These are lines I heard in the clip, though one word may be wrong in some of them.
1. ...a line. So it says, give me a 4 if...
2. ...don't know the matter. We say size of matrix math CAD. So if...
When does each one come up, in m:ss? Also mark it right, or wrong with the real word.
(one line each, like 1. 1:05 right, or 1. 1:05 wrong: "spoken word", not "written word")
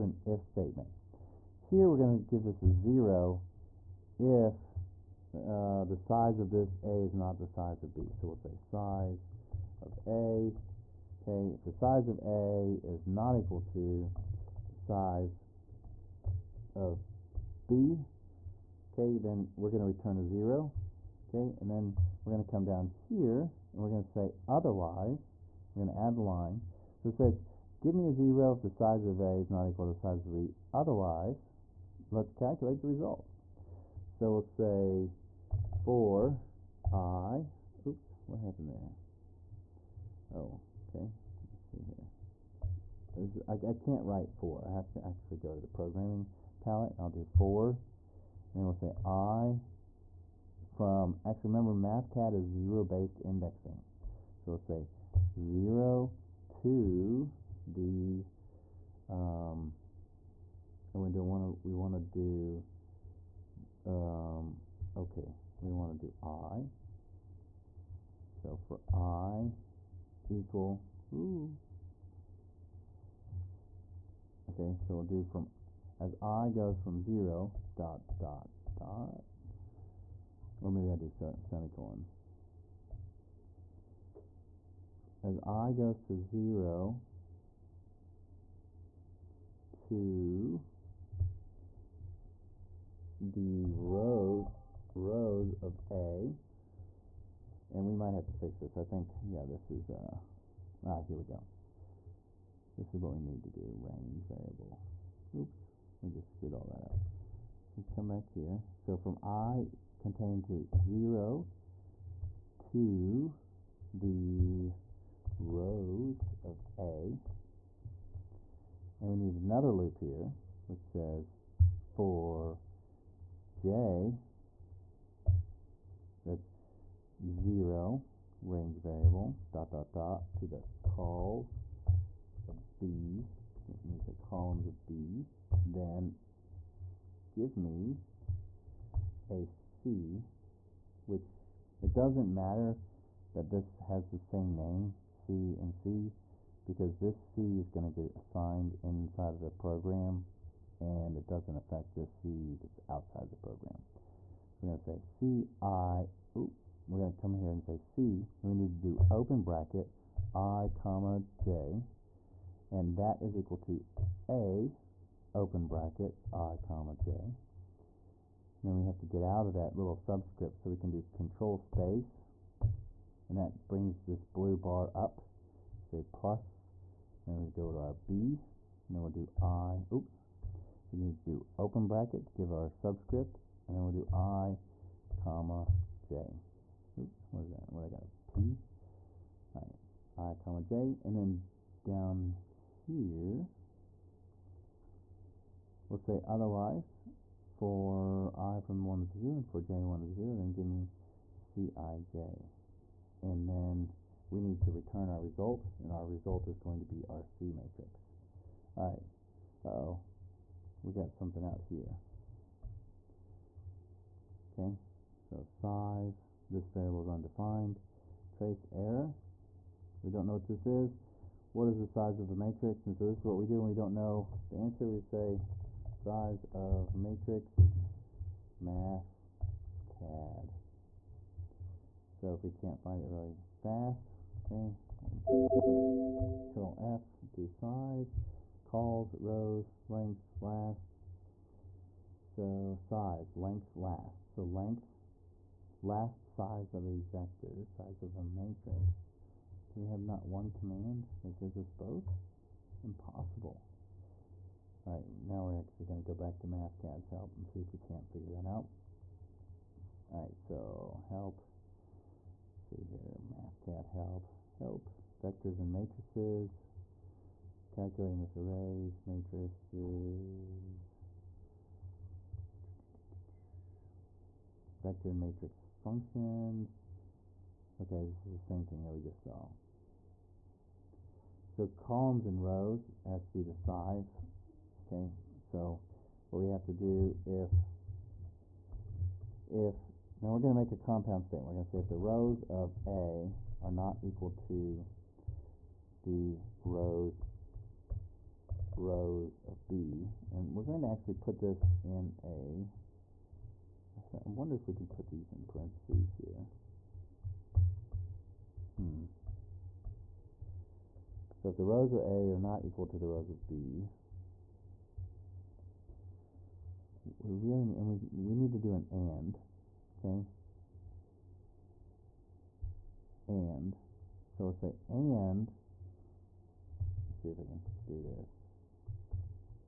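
1. 0:26 wrong: "0", not "4"
2. 3:43 wrong: "answer", not "matter".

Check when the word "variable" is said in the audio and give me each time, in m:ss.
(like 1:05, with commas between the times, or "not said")
1:44, 2:08, 3:36.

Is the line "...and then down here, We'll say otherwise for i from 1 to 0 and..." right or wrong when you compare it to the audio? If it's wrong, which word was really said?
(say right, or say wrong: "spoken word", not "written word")
right.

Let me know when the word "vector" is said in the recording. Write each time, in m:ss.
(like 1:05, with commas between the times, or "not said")
4:06, 4:25, 4:34.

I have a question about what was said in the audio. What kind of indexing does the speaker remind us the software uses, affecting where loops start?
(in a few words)
zero based indexing.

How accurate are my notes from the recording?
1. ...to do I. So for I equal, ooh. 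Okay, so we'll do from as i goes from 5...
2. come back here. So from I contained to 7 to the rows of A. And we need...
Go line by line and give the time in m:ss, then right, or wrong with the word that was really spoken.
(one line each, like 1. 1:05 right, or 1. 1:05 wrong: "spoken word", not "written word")
1. 1:05 wrong: "0", not "5"
2. 1:47 wrong: "0", not "7".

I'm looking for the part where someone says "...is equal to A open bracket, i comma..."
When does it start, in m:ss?
2:43.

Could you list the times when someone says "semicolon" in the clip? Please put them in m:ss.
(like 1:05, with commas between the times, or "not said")
1:21.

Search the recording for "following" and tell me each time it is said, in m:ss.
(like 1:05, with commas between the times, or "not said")
not said.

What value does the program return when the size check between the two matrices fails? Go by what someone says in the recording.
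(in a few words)
0.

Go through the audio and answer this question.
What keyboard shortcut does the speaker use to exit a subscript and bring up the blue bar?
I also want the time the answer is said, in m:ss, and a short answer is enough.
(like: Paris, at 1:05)
control space, at 2:51.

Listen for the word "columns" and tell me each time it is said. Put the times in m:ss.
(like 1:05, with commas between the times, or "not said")
2:14, 4:41.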